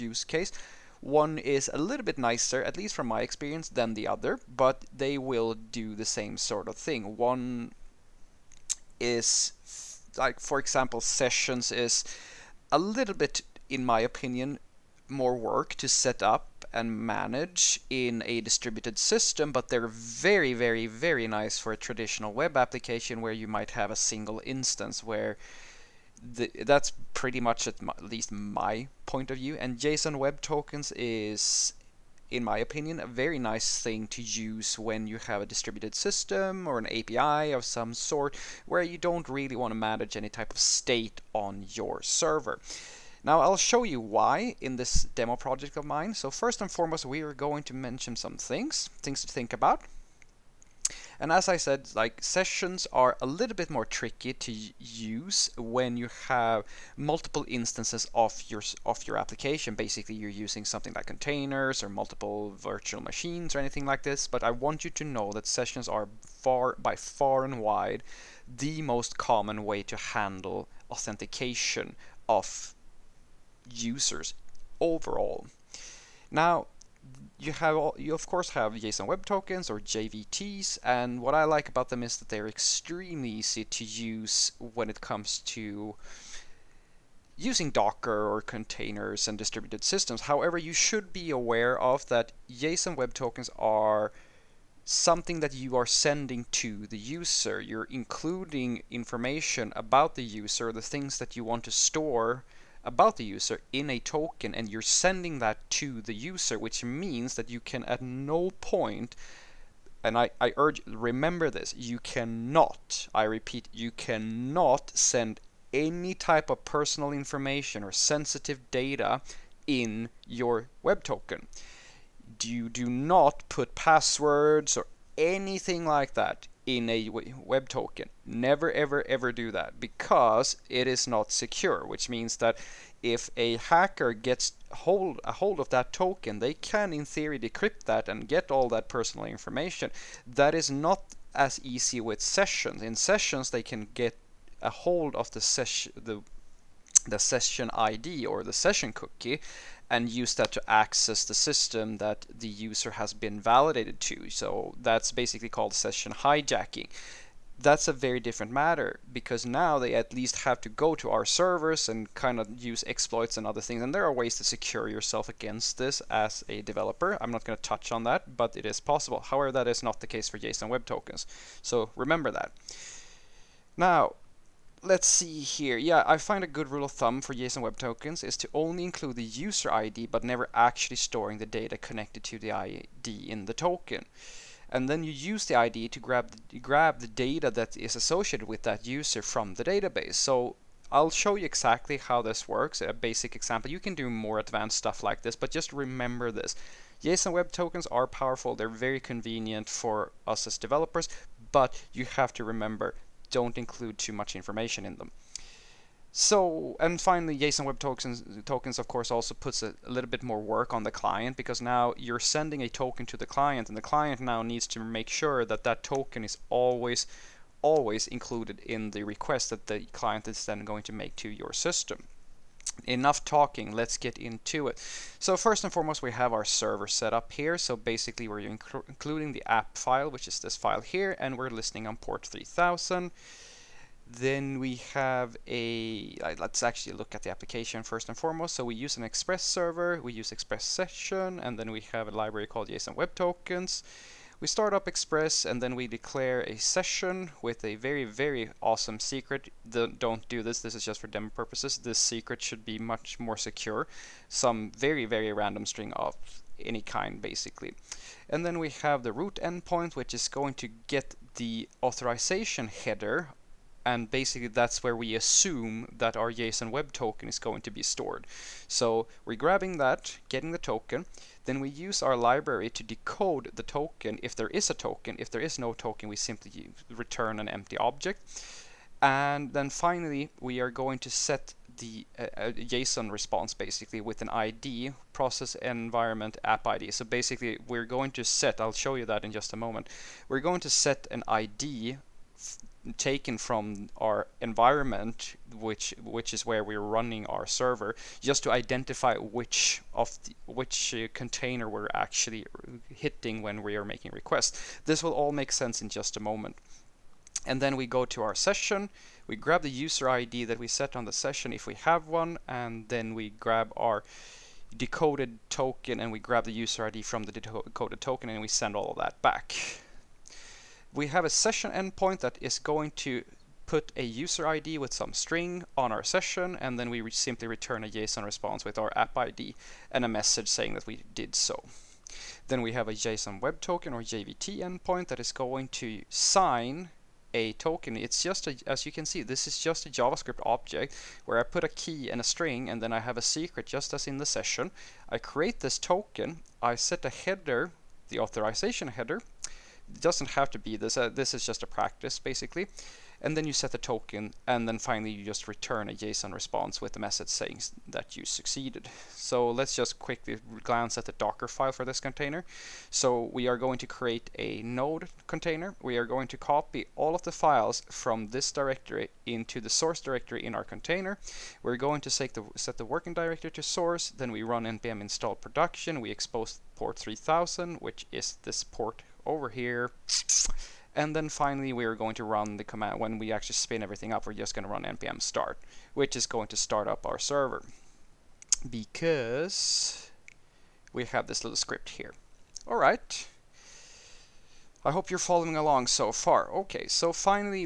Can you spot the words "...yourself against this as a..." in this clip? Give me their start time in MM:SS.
02:44.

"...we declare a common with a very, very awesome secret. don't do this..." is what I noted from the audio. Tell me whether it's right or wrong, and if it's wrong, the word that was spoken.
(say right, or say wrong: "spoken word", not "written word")
wrong: "session", not "common".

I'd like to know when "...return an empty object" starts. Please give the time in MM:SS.
04:36.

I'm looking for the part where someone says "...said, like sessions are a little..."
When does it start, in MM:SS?
00:51.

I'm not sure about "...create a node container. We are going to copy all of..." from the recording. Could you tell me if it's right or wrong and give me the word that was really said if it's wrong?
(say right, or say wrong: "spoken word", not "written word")
right.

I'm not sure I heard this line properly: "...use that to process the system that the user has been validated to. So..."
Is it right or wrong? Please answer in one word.
wrong.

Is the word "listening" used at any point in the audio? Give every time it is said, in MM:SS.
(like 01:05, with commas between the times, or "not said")
03:51.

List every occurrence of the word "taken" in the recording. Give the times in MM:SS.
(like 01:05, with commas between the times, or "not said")
04:52.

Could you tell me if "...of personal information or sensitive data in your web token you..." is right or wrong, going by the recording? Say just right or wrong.
right.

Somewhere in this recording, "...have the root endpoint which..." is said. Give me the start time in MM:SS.
04:18.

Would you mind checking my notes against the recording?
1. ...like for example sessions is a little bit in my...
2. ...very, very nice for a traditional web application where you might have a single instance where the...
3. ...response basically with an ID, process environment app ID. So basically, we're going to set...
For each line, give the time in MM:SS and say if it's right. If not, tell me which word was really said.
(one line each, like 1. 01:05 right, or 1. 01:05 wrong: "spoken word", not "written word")
1. 00:10 right
2. 00:20 right
3. 04:43 right.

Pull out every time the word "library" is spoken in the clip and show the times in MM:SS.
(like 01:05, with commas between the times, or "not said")
04:02, 04:32.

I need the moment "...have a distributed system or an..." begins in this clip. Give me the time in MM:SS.
00:35.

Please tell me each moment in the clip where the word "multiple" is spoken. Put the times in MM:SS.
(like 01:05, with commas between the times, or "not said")
00:56, 01:01.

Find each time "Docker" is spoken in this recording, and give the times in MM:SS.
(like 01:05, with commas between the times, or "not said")
01:27, 06:01.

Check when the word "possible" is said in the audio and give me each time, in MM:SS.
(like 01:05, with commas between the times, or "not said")
02:48.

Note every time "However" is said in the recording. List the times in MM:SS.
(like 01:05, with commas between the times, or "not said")
01:30, 02:49.